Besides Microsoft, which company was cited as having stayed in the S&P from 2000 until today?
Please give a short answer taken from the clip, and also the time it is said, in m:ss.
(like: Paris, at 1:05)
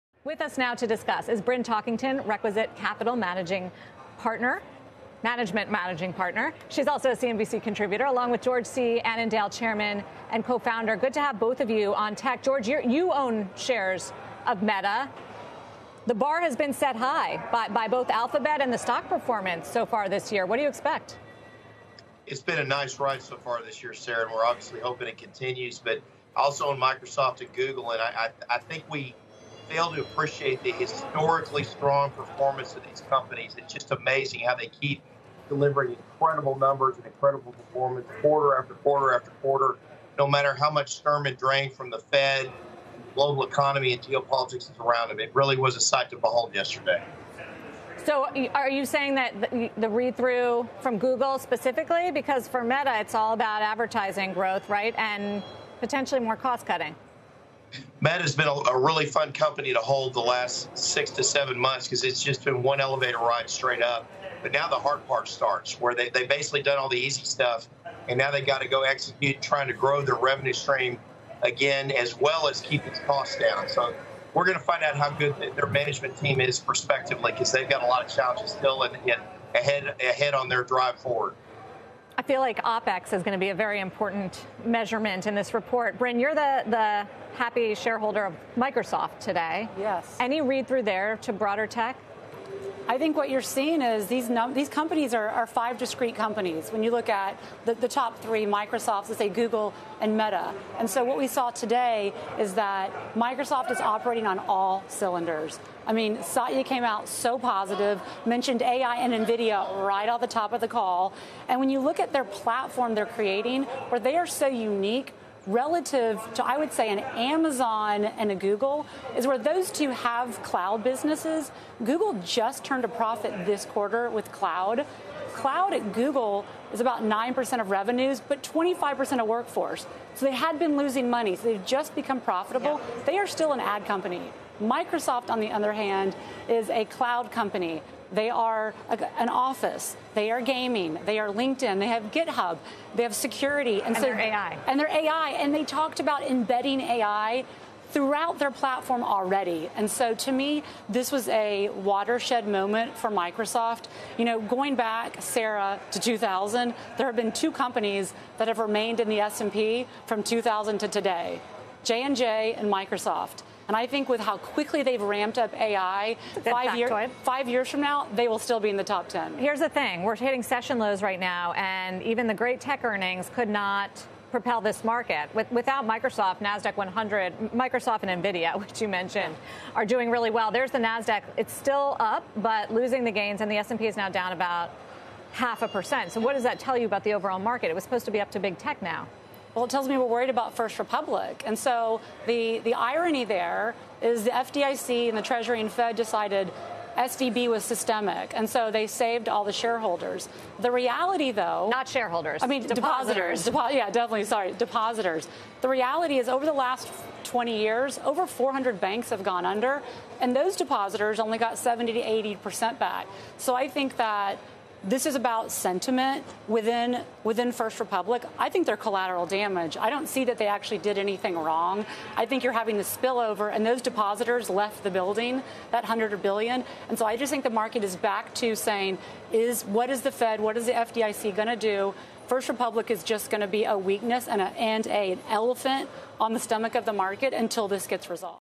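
J&J, at 2:41.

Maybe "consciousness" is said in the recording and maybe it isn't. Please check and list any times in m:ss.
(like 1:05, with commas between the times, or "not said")
not said.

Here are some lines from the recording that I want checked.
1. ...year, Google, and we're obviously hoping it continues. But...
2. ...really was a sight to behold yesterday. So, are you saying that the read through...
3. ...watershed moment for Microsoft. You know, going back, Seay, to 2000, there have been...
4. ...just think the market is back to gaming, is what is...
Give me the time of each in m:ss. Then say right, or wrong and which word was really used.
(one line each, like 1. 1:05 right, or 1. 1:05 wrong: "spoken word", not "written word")
1. 0:23 wrong: "Sarah", not "Google"
2. 0:45 right
3. 2:31 wrong: "Sarah", not "Seay"
4. 3:47 wrong: "saying", not "gaming".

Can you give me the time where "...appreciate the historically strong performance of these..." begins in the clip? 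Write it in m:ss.
0:30.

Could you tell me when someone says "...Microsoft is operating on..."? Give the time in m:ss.
1:43.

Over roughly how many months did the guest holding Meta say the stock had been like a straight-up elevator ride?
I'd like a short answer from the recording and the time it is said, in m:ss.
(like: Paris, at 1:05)
6 to 7 months, at 1:00.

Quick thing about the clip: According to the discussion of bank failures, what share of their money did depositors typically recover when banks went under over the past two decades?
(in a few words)
70 to 80 percent.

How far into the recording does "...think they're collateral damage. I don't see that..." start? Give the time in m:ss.
3:38.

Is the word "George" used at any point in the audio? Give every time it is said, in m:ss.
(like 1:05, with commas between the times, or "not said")
0:08, 0:12.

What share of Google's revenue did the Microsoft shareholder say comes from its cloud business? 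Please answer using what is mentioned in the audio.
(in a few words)
9%.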